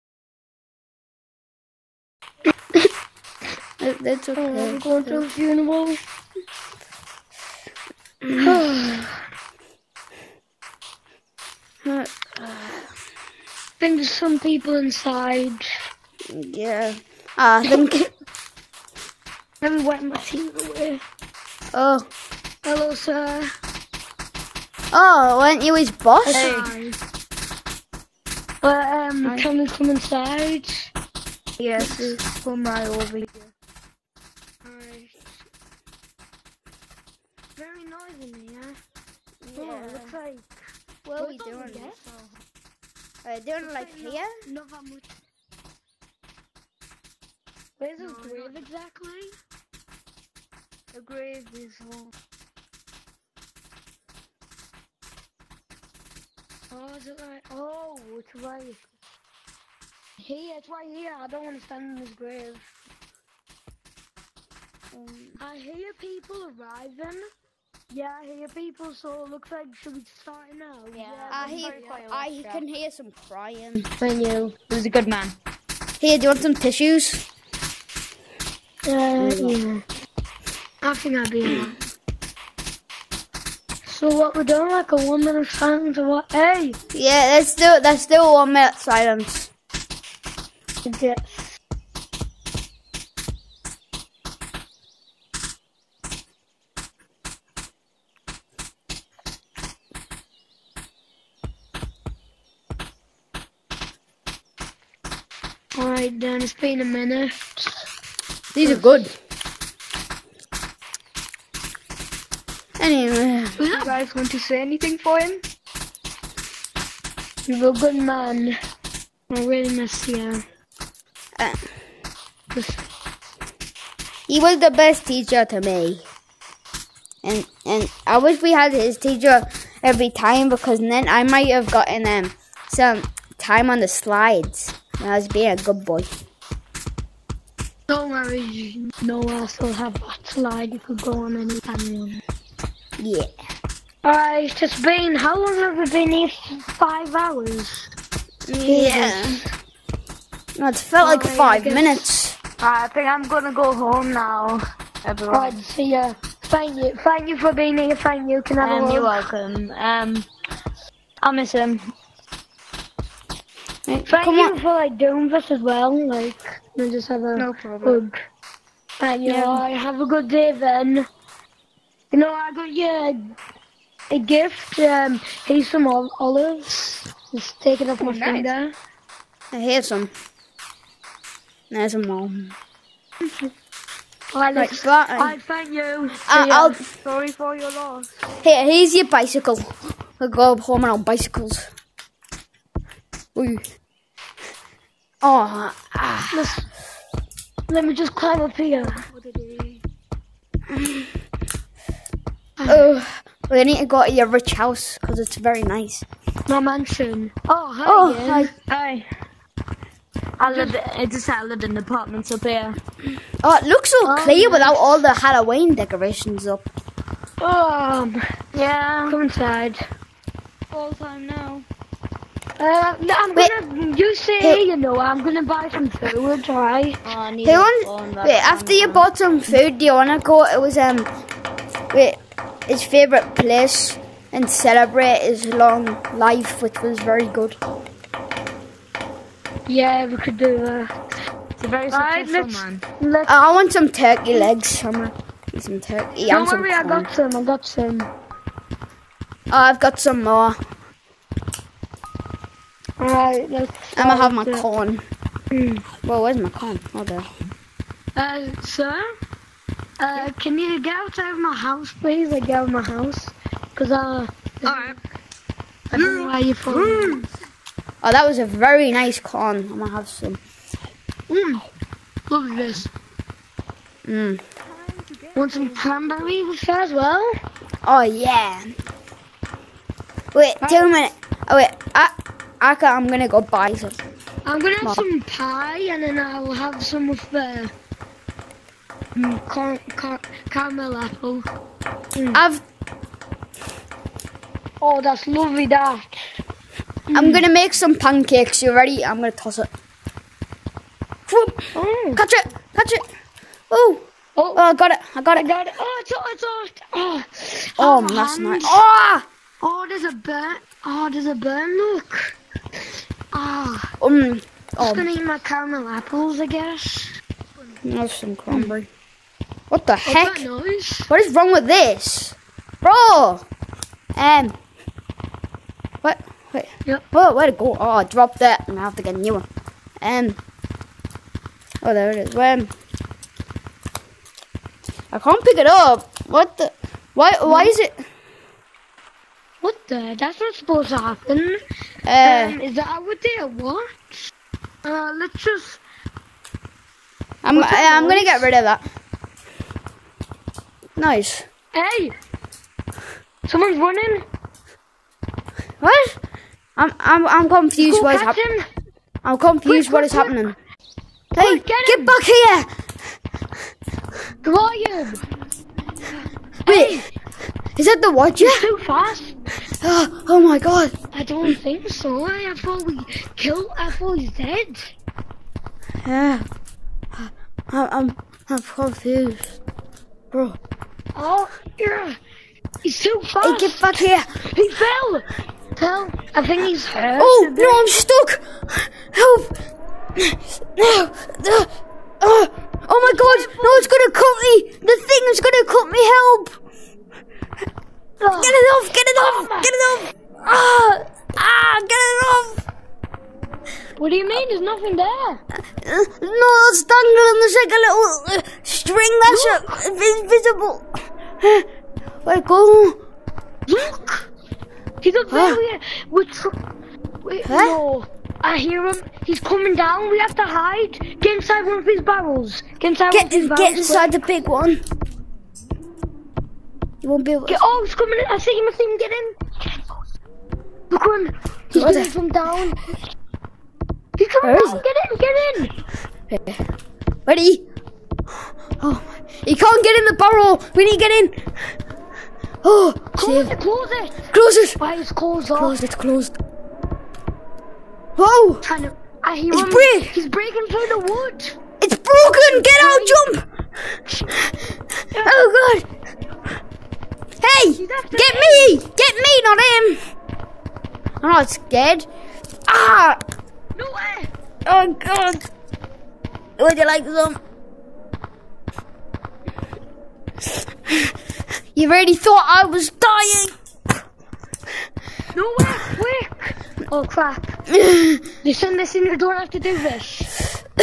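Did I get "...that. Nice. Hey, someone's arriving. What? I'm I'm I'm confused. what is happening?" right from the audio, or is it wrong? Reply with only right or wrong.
wrong.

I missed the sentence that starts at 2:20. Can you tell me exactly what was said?
You could go on any time you want.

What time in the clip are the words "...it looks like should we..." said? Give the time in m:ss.
1:09.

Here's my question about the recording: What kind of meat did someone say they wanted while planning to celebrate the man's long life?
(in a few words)
Turkey legs.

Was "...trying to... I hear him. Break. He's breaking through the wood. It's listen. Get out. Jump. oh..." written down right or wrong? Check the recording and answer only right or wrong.
wrong.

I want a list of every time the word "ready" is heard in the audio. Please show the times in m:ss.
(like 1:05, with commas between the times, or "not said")
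4:58, 7:17.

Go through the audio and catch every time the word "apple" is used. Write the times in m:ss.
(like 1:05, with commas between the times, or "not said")
4:50, 5:15.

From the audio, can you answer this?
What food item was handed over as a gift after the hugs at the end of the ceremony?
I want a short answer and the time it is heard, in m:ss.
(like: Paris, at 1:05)
Olives, at 2:55.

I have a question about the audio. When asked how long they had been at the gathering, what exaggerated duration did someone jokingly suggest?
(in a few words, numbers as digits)
Five hours.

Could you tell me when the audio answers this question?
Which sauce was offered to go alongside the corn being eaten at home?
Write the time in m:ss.
4:35.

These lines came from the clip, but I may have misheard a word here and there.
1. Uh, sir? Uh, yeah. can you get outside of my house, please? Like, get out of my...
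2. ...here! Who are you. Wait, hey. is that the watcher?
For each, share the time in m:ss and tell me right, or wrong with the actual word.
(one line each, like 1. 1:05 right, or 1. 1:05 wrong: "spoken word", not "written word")
1. 4:18 right
2. 6:02 right.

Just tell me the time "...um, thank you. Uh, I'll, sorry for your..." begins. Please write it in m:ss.
3:05.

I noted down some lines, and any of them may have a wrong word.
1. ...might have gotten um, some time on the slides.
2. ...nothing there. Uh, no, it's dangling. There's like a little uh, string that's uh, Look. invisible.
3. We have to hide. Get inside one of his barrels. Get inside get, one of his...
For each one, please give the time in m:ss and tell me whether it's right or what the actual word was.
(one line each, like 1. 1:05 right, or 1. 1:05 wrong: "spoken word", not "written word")
1. 2:11 right
2. 6:44 right
3. 7:00 right.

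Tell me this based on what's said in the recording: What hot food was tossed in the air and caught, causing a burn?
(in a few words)
Pancakes.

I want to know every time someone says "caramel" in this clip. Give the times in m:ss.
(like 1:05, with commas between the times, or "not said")
4:50, 5:15.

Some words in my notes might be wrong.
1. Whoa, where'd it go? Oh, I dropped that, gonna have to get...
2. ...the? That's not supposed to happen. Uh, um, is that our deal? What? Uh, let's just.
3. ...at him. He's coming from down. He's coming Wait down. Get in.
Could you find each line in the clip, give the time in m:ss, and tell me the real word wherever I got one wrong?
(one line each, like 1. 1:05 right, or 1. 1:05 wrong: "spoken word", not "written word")
1. 5:27 right
2. 5:39 right
3. 7:11 wrong: "Where", not "Wait".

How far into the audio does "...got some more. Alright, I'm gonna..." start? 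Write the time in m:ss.
4:09.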